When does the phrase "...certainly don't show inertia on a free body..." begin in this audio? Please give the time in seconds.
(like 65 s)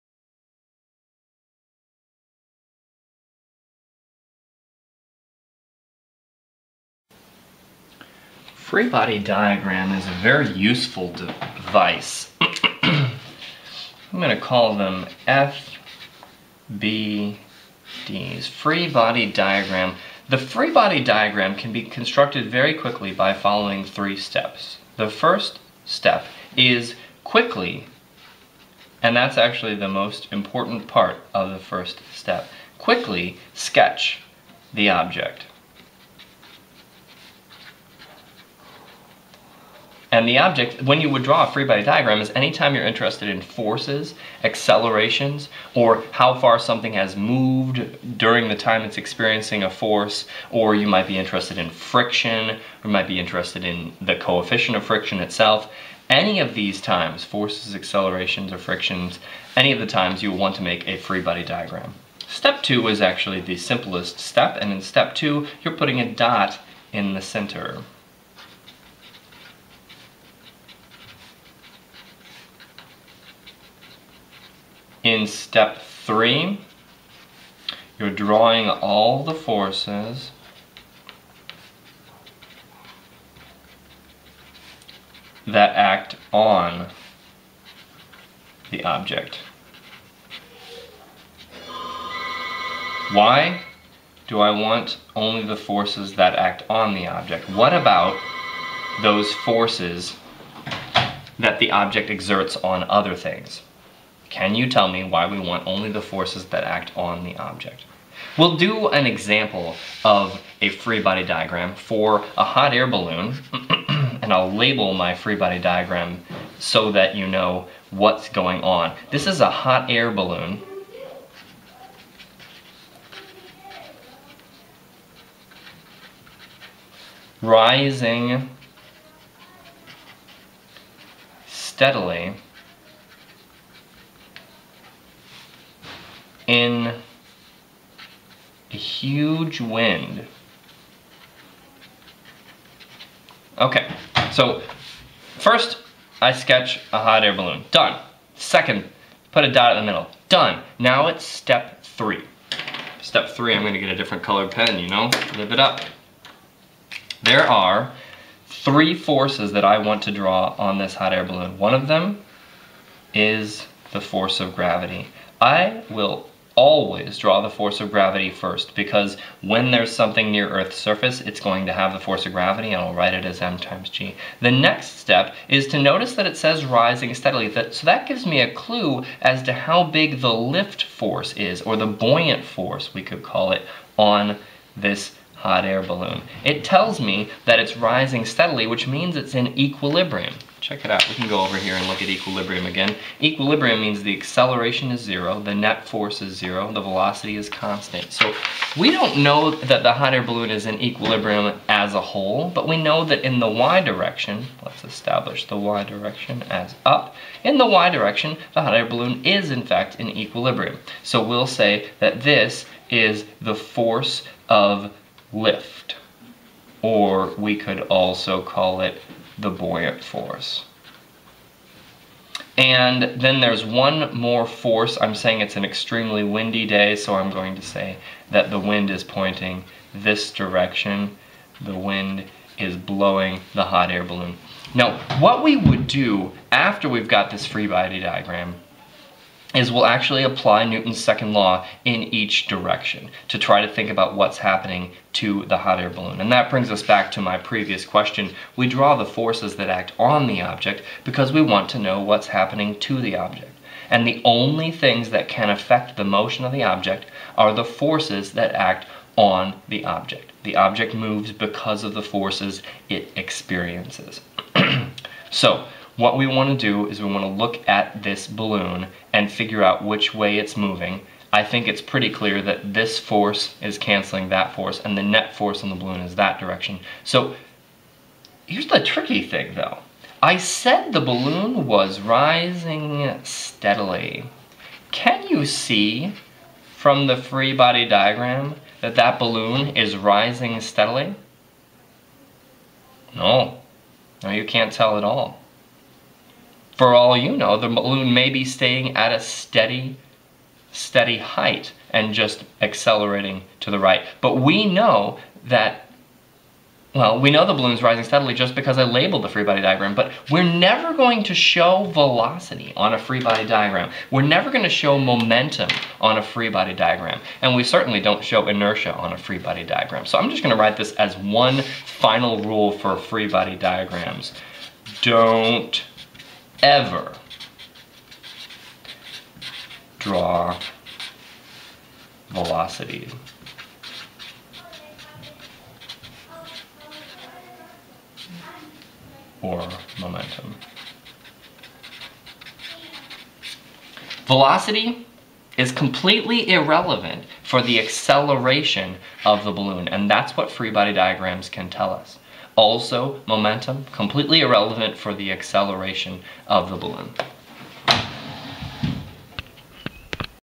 317 s.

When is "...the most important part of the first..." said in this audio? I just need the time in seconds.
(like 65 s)
29 s.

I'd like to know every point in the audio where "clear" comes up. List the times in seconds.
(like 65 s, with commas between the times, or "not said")
272 s.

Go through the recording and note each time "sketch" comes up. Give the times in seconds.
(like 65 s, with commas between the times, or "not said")
33 s, 146 s.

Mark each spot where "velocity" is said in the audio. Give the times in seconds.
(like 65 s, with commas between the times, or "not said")
196 s, 311 s, 332 s, 344 s.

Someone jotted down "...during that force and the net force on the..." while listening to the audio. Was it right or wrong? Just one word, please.
wrong.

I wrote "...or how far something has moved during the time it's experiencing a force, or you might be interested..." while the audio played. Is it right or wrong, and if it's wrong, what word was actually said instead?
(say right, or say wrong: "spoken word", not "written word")
right.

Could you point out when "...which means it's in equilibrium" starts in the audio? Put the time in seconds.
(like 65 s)
188 s.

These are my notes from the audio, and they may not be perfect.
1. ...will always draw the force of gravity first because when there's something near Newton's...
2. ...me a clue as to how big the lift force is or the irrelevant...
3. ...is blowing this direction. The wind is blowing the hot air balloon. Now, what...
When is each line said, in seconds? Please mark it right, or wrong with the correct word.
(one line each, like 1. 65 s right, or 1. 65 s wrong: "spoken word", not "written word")
1. 165 s wrong: "Earth", not "Newton"
2. 178 s wrong: "buoyant", not "irrelevant"
3. 228 s wrong: "pointing", not "blowing".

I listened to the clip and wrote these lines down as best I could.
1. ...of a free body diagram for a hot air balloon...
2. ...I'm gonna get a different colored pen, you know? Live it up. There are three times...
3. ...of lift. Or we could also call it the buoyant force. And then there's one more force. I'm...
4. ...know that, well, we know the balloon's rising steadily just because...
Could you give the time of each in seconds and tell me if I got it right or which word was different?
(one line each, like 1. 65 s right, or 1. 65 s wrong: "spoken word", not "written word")
1. 110 s right
2. 153 s wrong: "forces", not "times"
3. 214 s right
4. 304 s right.